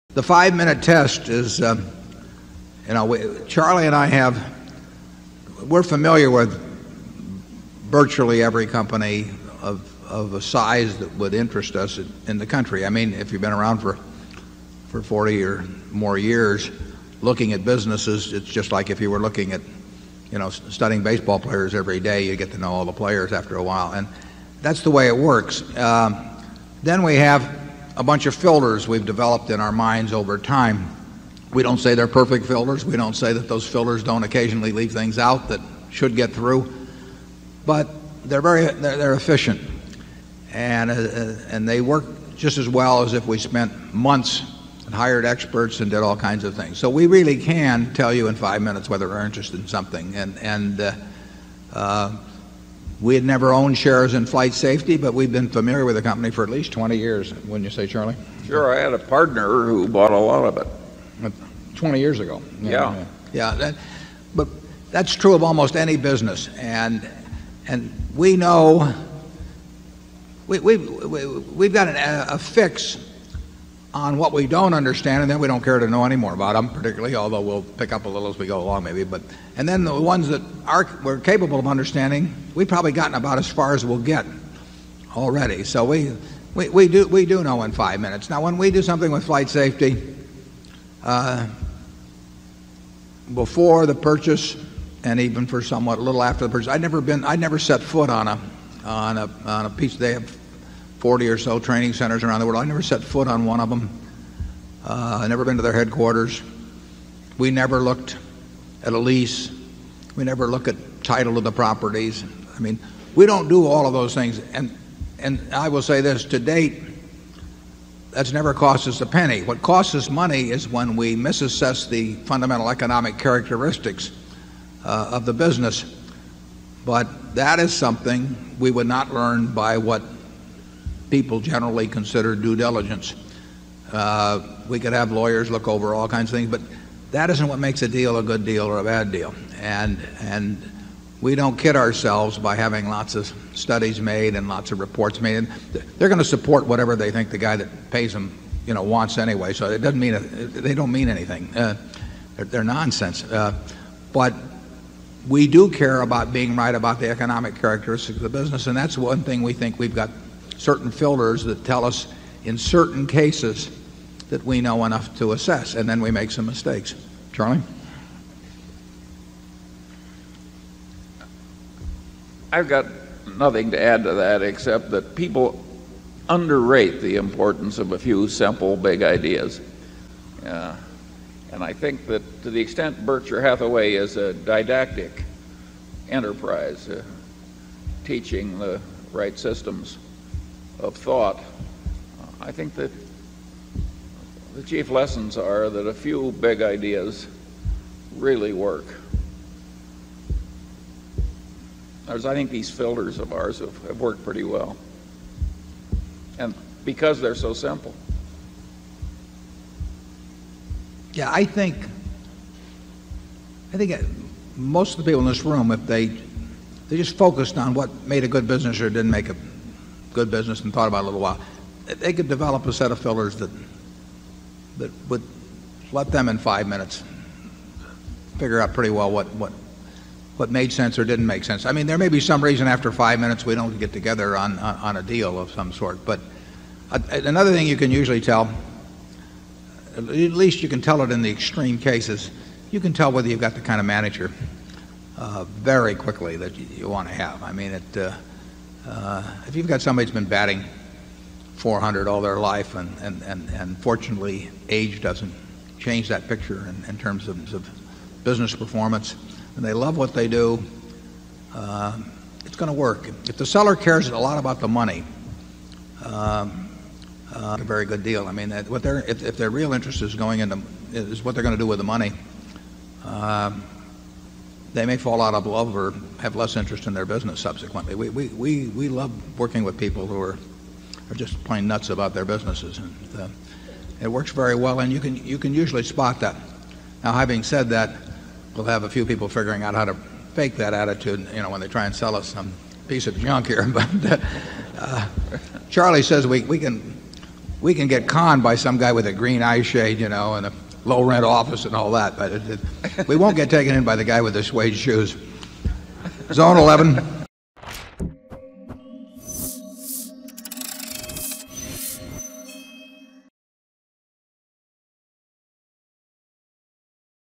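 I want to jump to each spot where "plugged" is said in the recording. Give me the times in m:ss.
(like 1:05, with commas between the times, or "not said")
not said.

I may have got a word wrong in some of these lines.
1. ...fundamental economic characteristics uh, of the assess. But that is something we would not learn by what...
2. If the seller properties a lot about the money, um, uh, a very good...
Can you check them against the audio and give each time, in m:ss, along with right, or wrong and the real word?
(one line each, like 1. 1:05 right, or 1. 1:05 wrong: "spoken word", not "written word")
1. 2:02 wrong: "business", not "assess"
2. 4:23 wrong: "cares", not "properties".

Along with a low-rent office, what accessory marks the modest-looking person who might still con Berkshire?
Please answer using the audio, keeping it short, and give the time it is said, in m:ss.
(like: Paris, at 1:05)
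Green eye shade, at 4:59.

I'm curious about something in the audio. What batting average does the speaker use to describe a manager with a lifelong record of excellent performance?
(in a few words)
400.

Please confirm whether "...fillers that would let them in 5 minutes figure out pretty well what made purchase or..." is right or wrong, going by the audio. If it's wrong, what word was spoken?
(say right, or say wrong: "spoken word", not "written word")
wrong: "sense", not "purchase".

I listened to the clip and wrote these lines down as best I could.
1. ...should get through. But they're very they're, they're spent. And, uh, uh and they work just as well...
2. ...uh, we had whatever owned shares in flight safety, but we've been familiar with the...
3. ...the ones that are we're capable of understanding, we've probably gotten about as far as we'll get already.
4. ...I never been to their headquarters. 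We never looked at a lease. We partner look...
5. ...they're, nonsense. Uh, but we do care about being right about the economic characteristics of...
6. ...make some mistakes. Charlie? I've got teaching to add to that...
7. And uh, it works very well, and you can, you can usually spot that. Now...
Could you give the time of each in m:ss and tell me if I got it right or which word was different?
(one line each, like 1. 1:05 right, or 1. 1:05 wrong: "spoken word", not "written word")
1. 0:35 wrong: "efficient", not "spent"
2. 0:51 wrong: "never", not "whatever"
3. 1:19 right
4. 1:45 wrong: "never", not "partner"
5. 2:32 right
6. 2:46 wrong: "nothing", not "teaching"
7. 4:42 right.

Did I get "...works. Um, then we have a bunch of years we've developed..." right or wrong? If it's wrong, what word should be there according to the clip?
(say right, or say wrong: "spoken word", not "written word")
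wrong: "filters", not "years".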